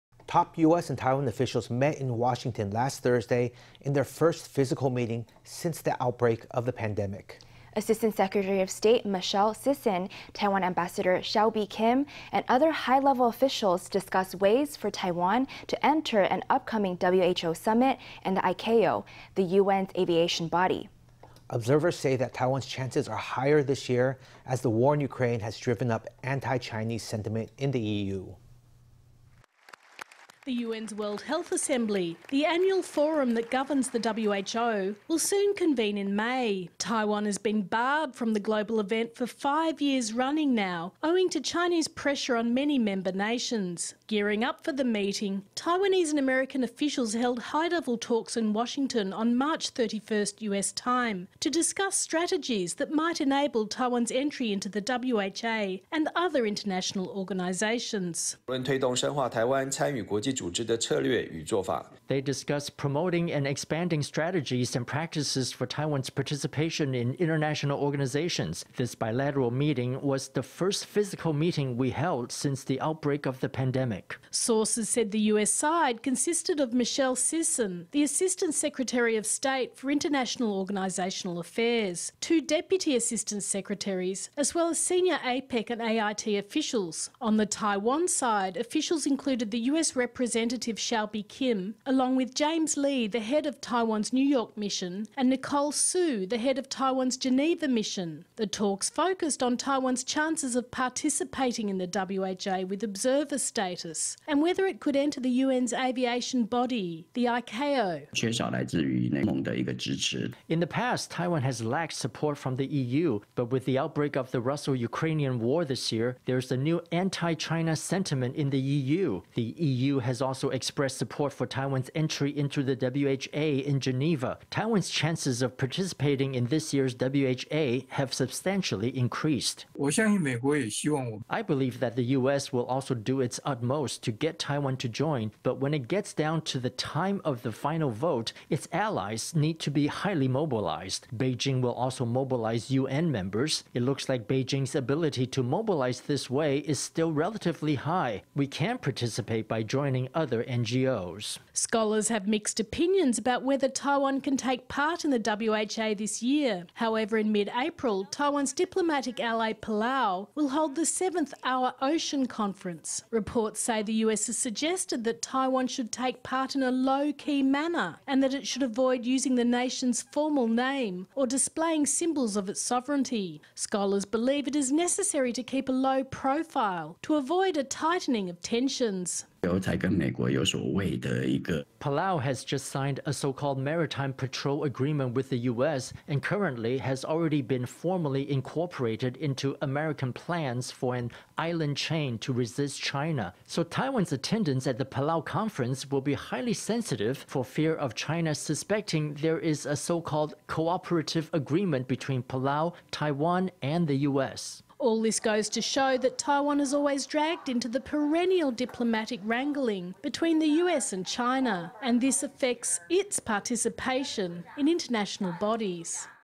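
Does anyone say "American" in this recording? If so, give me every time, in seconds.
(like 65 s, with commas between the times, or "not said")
46 s, 189 s.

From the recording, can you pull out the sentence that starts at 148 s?
We can participate by joining other NGOs.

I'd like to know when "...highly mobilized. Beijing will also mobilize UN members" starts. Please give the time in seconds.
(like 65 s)
139 s.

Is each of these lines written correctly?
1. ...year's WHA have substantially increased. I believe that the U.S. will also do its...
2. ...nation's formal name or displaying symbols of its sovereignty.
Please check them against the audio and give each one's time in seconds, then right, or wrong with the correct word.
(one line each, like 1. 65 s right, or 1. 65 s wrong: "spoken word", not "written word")
1. 126 s right
2. 169 s right.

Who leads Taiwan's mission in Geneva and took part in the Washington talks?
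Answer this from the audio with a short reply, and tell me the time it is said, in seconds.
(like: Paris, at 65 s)
Nicole Su, at 95 s.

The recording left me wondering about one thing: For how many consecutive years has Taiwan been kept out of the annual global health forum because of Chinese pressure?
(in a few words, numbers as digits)
5.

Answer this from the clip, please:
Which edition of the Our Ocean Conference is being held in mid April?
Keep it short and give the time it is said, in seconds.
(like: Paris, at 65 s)
7th, at 160 s.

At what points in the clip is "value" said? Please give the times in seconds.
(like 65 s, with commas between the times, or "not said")
not said.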